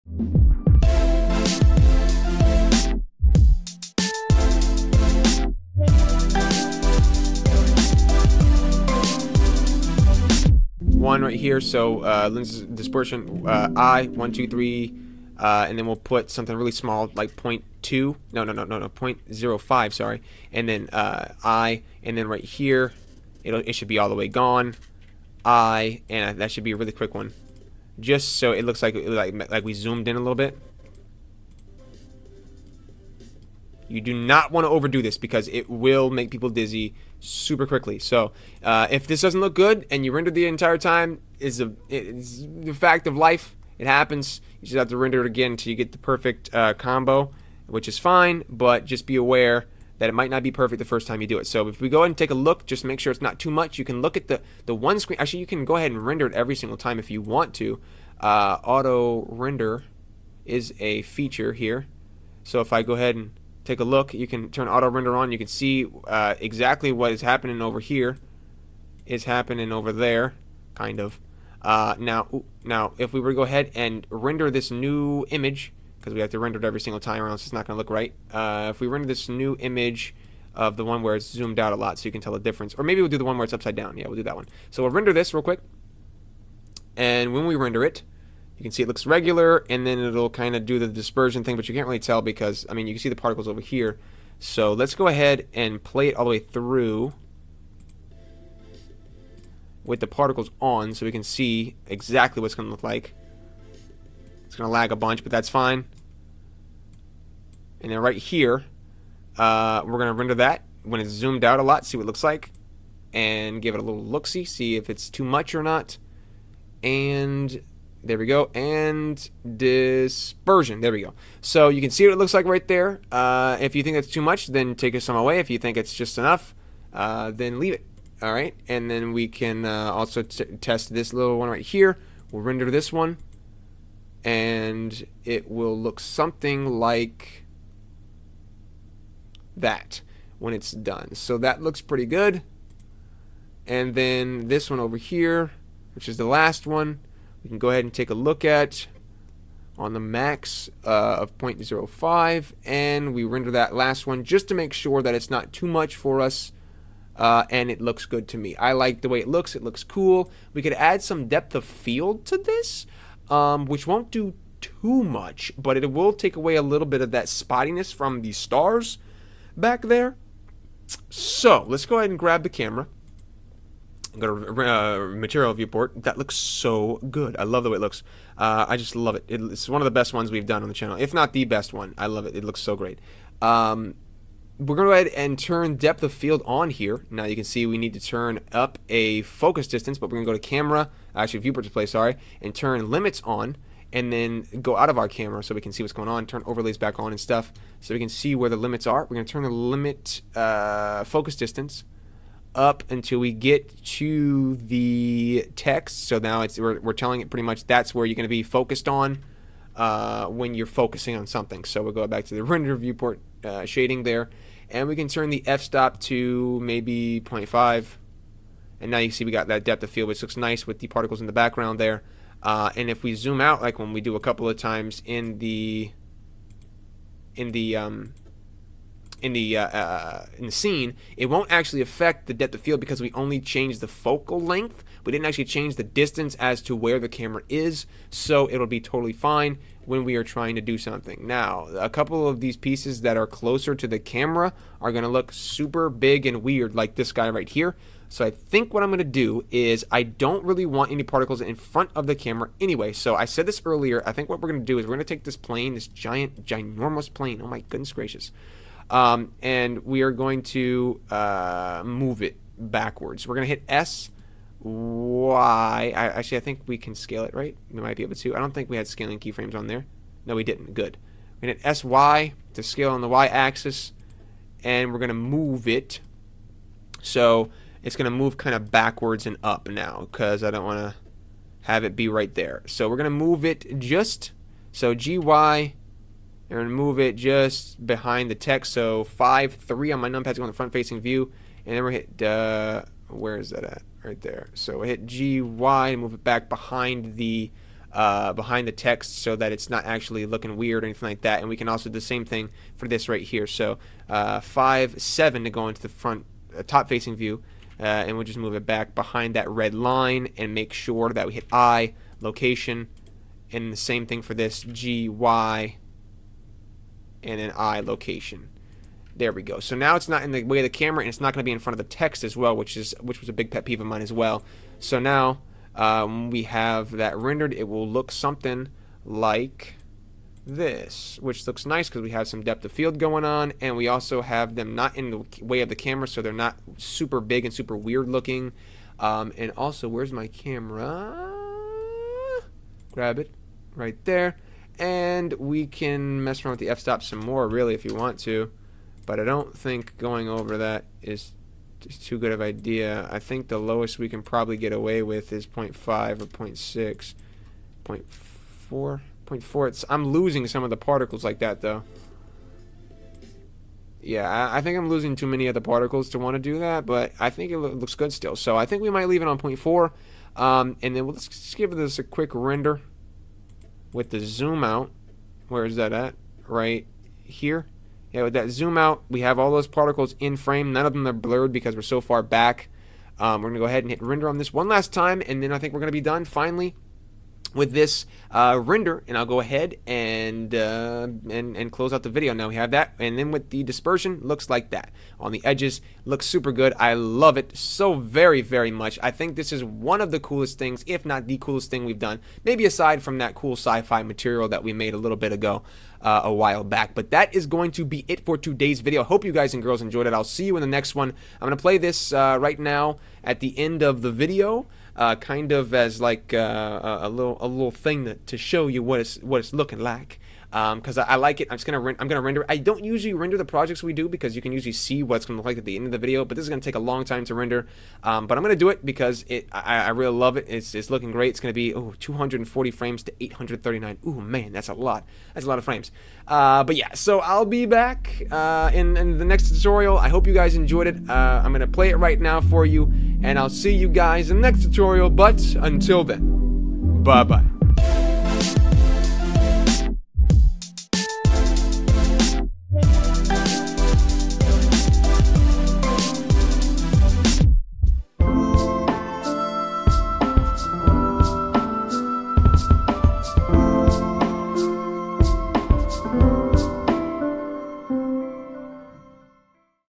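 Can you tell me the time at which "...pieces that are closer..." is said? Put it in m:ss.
4:02.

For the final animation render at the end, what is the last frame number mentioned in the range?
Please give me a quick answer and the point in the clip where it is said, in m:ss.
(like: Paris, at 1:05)
839, at 7:13.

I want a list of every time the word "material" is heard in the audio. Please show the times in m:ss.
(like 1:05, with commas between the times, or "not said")
2:55, 6:44.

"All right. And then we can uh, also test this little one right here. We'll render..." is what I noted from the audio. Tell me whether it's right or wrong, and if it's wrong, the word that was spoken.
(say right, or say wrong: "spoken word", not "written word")
right.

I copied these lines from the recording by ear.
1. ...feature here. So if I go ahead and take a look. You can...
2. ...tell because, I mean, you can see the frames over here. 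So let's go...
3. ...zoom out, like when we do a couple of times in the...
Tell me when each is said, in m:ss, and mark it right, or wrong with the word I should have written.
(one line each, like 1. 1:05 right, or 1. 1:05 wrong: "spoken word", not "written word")
1. 1:01 right
2. 1:31 wrong: "particles", not "frames"
3. 3:43 right.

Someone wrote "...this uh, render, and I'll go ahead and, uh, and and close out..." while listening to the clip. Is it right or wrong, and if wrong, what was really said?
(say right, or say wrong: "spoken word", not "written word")
right.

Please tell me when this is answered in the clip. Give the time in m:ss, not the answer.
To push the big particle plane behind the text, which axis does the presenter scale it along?
4:33.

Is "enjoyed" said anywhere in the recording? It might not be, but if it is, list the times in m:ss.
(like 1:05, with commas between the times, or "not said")
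6:49, 7:20.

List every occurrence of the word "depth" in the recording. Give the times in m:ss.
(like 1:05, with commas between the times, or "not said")
2:41, 3:05, 3:39, 3:52, 5:32.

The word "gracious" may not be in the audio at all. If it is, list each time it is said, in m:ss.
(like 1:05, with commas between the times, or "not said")
4:17.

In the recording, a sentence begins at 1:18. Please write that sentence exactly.
Uh, if we render this new image of the one where it's zoomed out a lot so you can tell the difference.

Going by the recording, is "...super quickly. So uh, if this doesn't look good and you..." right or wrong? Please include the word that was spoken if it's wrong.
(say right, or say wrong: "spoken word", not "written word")
right.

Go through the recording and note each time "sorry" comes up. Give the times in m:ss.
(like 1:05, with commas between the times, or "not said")
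0:19, 3:11.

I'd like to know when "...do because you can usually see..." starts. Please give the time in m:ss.
7:03.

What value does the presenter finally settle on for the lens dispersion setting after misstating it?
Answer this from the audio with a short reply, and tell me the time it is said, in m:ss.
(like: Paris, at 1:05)
0.05, at 0:18.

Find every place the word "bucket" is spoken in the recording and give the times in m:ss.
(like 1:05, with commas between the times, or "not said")
not said.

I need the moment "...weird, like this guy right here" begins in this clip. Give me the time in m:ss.
4:06.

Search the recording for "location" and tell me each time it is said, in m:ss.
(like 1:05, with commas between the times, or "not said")
5:12, 5:17.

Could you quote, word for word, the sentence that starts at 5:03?
So uh, 5, 7 to go into the front uh, top facing view.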